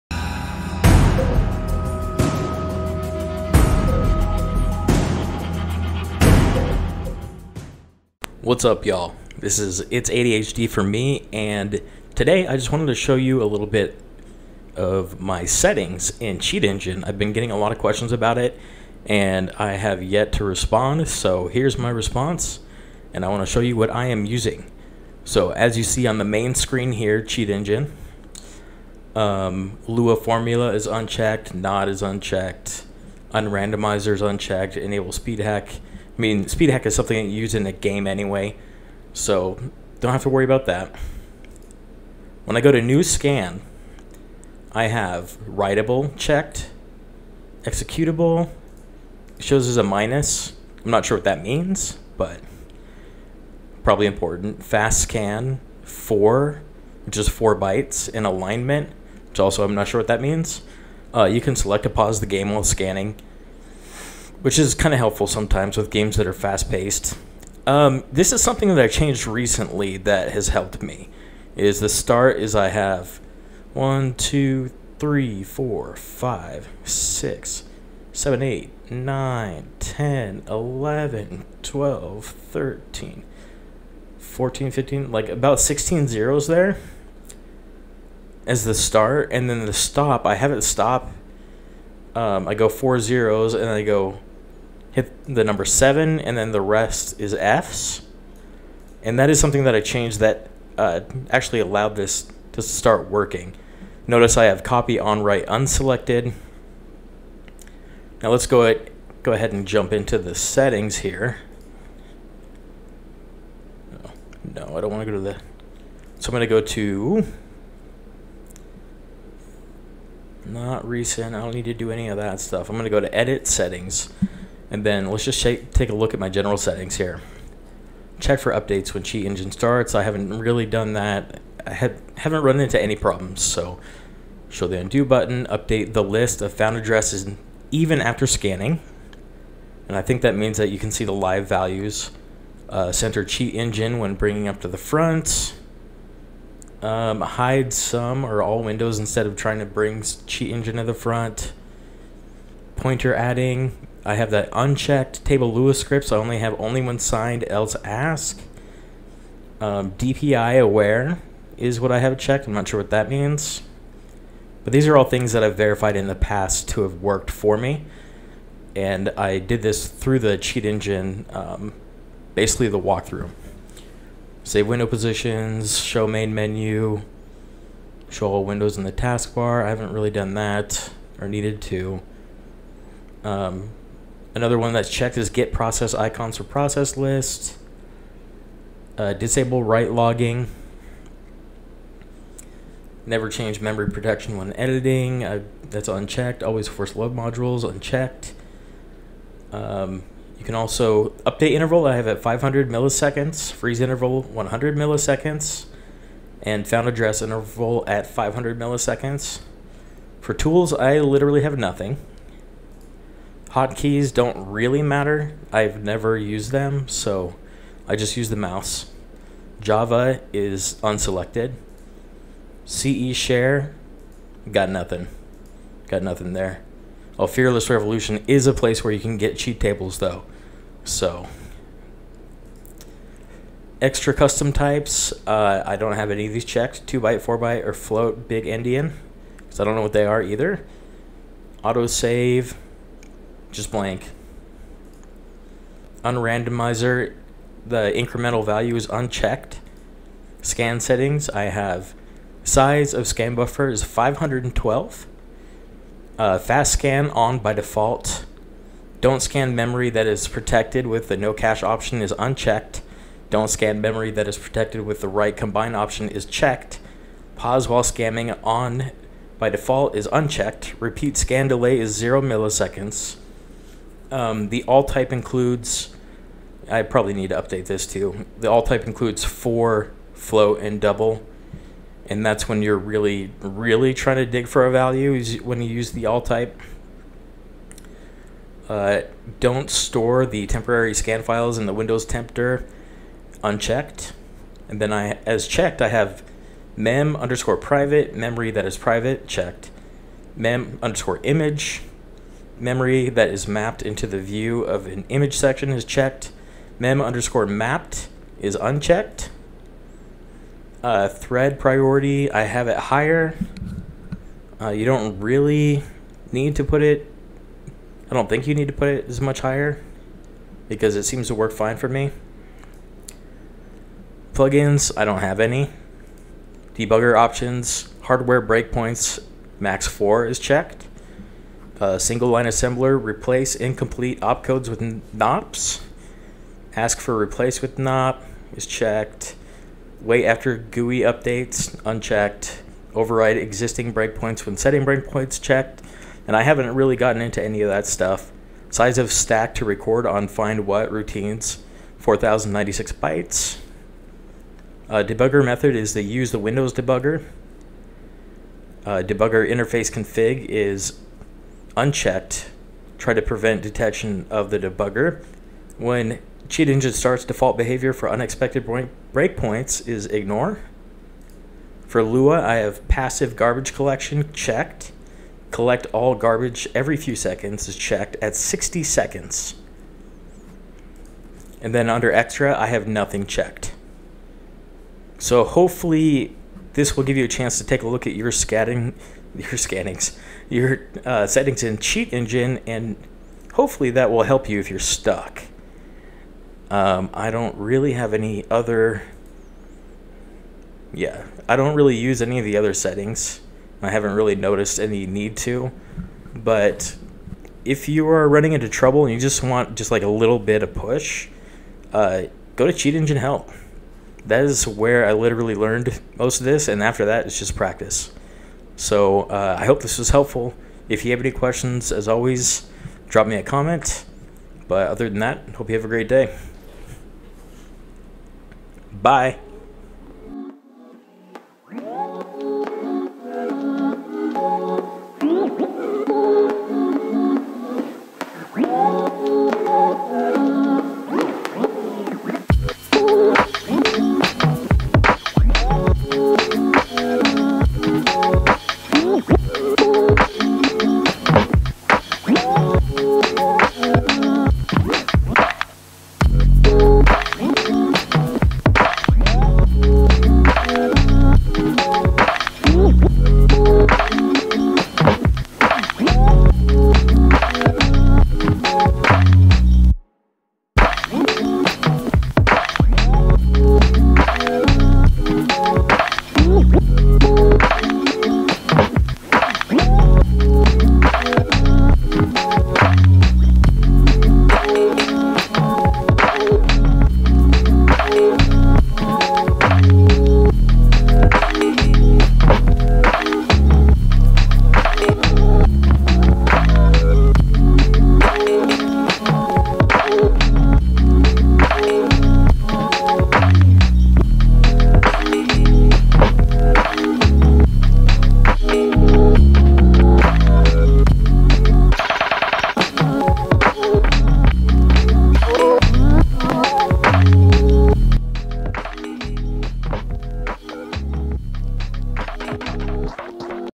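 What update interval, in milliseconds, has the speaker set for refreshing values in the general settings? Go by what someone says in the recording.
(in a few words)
500 milliseconds.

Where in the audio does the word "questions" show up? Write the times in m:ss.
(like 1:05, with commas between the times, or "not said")
0:17, 7:01.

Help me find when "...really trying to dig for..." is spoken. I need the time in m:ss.
4:43.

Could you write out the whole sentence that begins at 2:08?
Check for updates when Cheat Engine starts.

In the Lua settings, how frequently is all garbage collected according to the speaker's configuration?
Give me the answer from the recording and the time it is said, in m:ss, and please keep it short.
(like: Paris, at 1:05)
60 seconds, at 6:18.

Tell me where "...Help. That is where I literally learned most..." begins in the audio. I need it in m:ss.
6:53.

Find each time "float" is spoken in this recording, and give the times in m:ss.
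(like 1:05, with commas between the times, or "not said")
3:57, 4:40.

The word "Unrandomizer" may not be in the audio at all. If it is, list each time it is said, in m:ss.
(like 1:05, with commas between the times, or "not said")
0:33, 4:06.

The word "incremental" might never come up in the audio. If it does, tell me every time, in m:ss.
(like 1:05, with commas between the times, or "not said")
4:07.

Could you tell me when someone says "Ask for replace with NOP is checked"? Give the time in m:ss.
5:36.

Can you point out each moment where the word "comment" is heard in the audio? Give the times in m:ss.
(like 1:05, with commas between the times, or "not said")
7:03.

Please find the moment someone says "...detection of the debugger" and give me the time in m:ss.
6:03.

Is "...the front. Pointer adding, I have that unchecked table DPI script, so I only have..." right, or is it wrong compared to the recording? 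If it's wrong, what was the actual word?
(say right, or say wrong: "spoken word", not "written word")
wrong: "Lua", not "DPI".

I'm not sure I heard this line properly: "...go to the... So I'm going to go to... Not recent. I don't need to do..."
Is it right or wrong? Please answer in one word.
right.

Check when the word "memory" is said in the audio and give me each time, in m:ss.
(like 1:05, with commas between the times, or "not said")
3:13, 4:19, 4:23, 4:58, 5:02.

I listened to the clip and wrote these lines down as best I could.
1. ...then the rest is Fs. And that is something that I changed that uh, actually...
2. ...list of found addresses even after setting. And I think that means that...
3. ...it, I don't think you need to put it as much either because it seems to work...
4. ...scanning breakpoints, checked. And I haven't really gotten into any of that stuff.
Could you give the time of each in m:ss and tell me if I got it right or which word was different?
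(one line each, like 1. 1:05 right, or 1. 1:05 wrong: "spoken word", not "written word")
1. 1:36 right
2. 2:16 wrong: "scanning", not "setting"
3. 5:16 wrong: "higher", not "either"
4. 5:44 wrong: "setting", not "scanning".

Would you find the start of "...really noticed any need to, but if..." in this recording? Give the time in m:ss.
6:44.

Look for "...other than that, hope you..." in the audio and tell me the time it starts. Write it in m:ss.
7:04.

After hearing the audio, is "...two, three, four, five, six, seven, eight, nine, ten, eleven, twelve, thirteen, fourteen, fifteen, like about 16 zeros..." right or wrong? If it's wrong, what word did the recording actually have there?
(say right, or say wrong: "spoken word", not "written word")
right.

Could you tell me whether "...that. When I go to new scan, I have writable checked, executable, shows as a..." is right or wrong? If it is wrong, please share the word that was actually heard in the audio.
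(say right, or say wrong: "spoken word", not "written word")
right.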